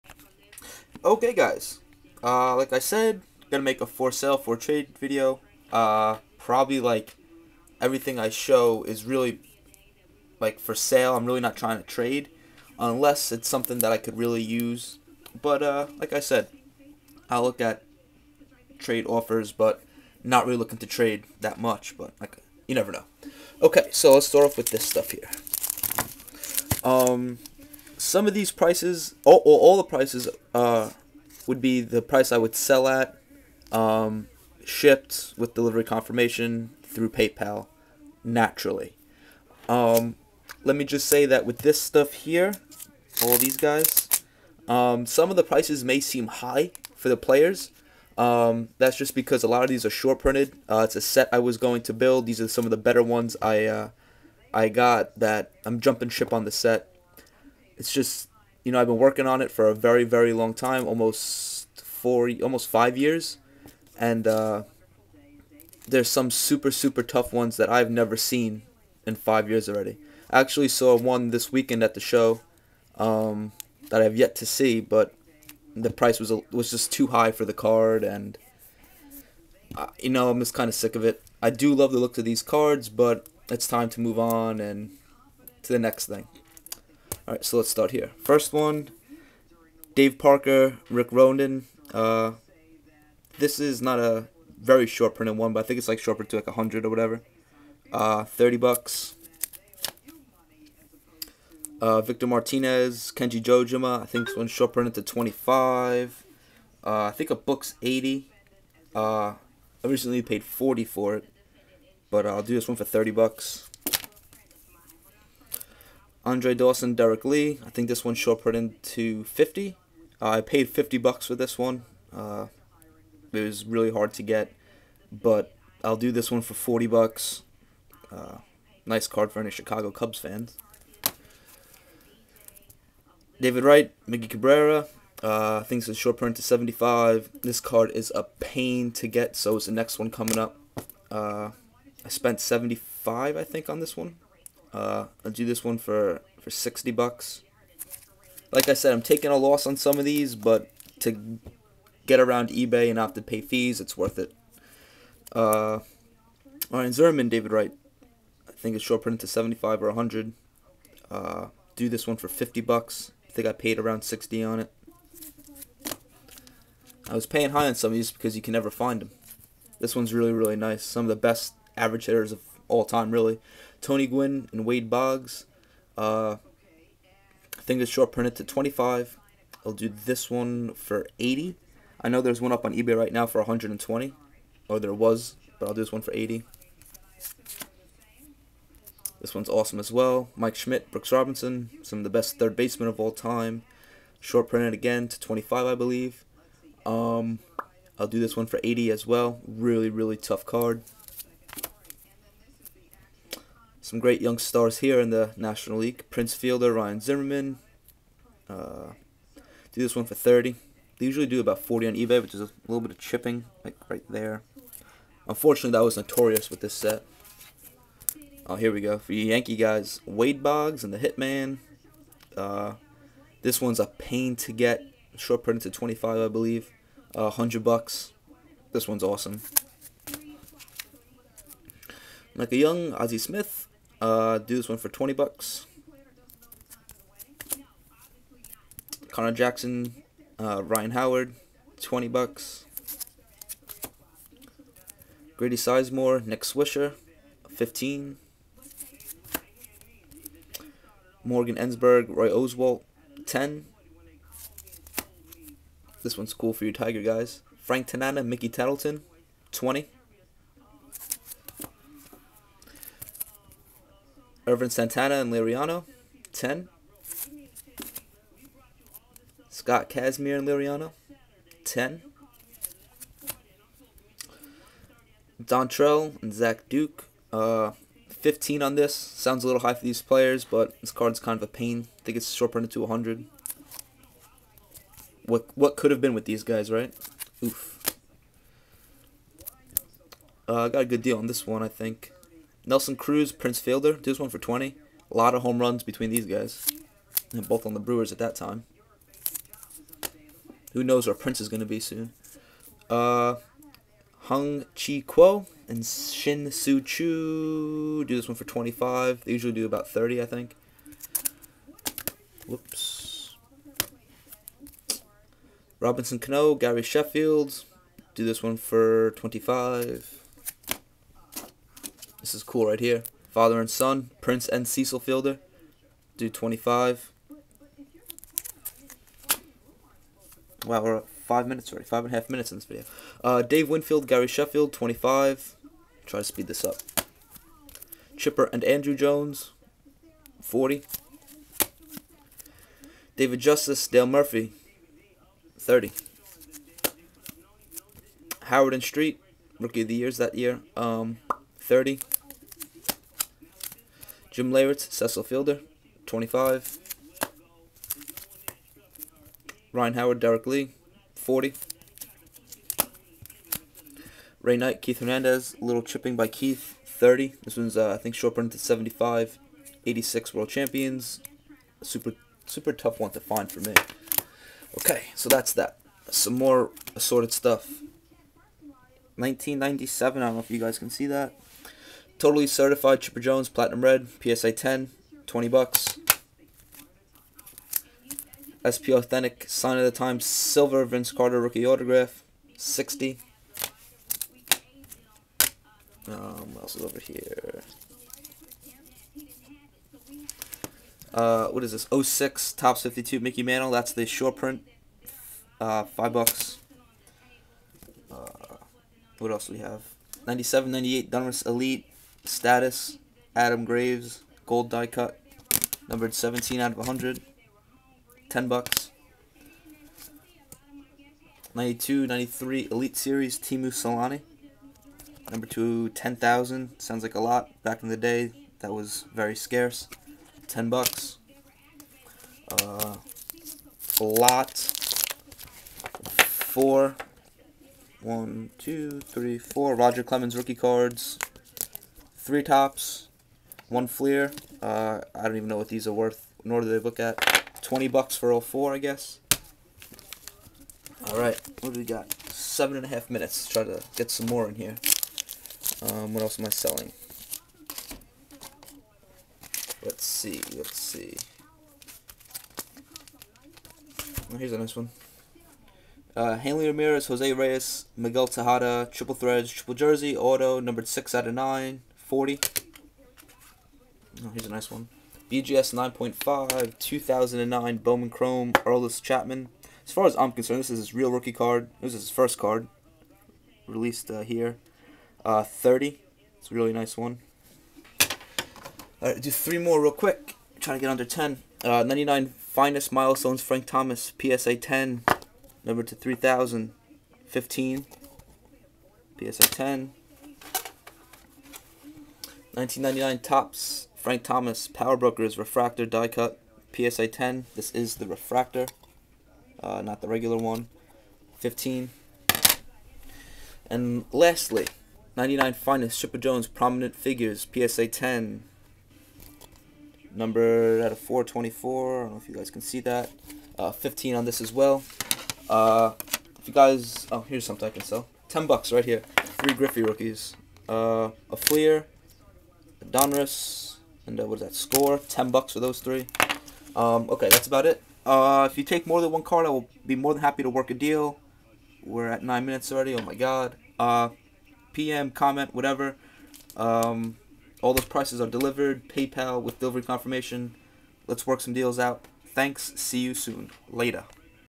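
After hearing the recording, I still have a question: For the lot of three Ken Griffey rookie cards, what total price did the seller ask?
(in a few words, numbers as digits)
$10.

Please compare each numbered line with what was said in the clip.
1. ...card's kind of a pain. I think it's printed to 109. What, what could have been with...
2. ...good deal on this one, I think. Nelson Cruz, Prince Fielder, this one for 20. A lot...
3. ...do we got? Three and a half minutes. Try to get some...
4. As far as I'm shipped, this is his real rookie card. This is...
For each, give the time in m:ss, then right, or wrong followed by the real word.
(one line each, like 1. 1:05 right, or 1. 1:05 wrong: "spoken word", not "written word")
1. 4:40 wrong: "100", not "109"
2. 4:50 right
3. 7:31 wrong: "Seven", not "Three"
4. 7:59 wrong: "concerned", not "shipped".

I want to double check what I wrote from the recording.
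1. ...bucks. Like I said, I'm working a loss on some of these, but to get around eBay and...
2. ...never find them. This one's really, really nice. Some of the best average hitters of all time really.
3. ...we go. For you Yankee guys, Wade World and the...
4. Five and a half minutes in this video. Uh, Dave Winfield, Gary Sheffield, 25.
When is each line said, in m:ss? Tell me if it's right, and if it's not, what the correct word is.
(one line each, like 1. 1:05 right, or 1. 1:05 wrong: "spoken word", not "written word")
1. 2:26 wrong: "taking", not "working"
2. 2:48 right
3. 3:38 wrong: "Boggs", not "World"
4. 5:31 right.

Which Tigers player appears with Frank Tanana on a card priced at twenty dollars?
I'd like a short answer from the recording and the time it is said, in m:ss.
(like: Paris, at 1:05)
Mickey Tettleton, at 4:18.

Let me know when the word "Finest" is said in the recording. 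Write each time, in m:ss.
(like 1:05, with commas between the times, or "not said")
8:12, 8:35.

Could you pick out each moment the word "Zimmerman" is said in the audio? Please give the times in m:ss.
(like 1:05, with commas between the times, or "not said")
2:36, 3:27.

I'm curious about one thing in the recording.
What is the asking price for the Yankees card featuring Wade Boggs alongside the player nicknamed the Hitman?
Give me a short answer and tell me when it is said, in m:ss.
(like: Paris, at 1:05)
$100, at 3:47.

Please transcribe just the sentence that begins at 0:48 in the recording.
Um, that's just because a lot of these are short printed.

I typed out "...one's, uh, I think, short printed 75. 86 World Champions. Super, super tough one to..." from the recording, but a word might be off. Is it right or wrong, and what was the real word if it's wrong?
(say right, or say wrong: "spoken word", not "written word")
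right.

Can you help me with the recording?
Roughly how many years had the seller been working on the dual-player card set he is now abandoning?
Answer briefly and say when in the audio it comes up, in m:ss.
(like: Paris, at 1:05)
almost 5, at 1:02.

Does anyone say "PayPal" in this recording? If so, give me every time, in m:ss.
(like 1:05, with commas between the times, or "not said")
0:37, 9:08.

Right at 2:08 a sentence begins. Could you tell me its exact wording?
Uh, nice card for any Chicago Cubs fans.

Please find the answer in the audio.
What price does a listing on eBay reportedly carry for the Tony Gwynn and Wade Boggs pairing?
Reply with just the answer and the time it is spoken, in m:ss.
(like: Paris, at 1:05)
$120, at 3:03.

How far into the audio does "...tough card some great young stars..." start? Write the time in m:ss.
3:20.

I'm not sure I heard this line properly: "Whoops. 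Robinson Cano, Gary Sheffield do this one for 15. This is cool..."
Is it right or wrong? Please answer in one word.
wrong.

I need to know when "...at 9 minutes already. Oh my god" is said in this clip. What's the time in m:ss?
9:02.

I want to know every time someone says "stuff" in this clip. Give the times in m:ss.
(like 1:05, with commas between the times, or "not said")
0:24, 0:41, 6:17.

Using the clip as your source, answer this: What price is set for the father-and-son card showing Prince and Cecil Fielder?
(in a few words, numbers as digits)
$25.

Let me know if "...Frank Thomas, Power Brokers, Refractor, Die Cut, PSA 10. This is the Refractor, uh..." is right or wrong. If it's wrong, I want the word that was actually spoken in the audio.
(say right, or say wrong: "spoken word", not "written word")
right.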